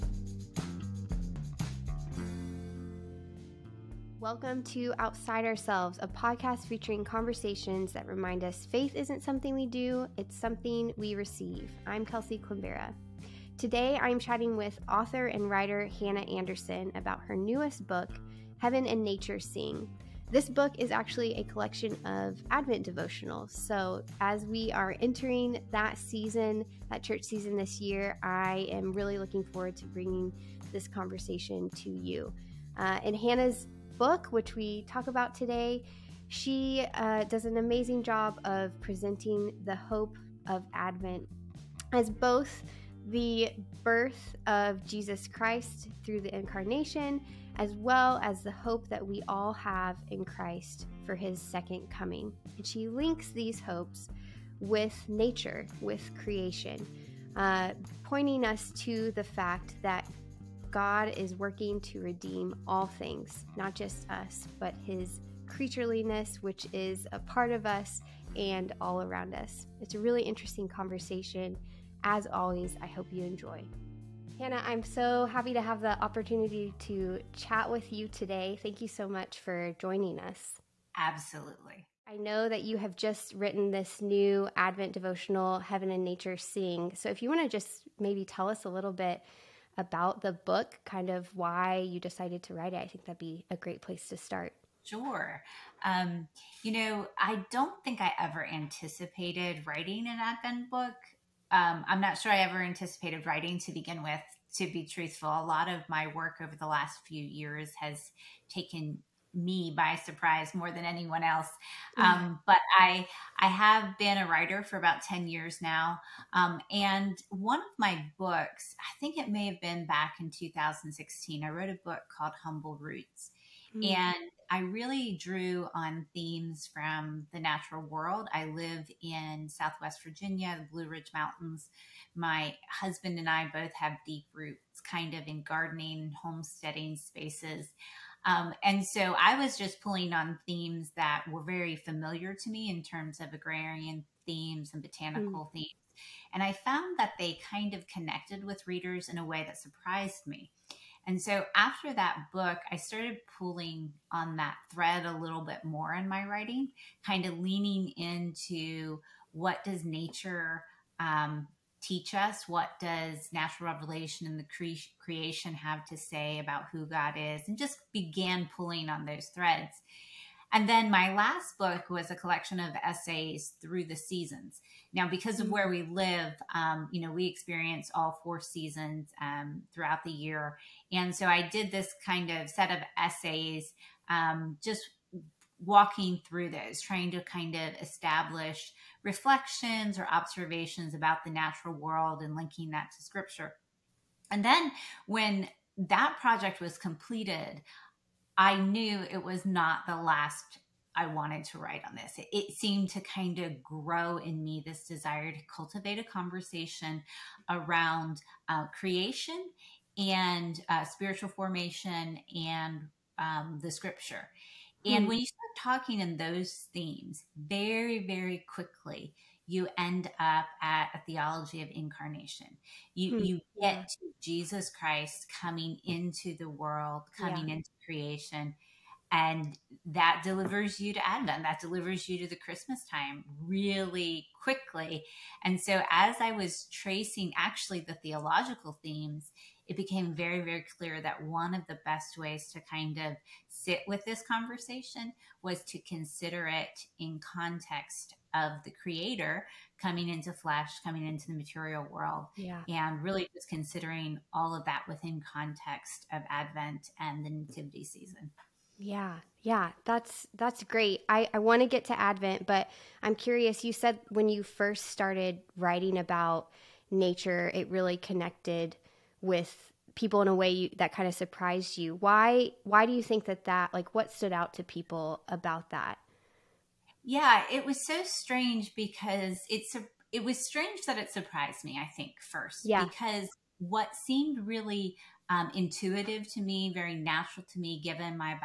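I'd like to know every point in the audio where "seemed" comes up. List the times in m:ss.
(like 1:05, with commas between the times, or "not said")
3:22, 4:44.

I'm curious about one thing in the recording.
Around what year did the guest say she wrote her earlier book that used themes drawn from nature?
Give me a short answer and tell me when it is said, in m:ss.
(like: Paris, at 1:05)
2016, at 2:00.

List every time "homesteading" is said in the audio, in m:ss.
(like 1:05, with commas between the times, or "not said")
2:16.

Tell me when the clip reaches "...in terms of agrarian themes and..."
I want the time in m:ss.
2:22.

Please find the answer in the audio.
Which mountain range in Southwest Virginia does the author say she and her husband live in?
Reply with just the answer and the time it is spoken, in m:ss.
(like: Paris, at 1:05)
Blue Ridge Mountains, at 2:10.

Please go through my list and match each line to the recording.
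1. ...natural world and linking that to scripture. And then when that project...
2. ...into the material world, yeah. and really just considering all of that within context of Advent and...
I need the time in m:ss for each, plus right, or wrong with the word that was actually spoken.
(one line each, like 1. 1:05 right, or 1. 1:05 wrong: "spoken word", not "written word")
1. 3:11 right
2. 4:11 right.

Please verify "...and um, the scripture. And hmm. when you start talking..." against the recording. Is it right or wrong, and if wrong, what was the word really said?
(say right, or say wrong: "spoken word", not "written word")
right.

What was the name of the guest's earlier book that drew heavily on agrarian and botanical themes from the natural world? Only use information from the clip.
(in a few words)
Humble Roots.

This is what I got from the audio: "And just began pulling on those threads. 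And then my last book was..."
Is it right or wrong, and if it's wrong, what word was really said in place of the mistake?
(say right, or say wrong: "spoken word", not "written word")
right.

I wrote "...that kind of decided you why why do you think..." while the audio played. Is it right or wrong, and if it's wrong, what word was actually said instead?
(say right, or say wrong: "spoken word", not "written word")
wrong: "surprised", not "decided".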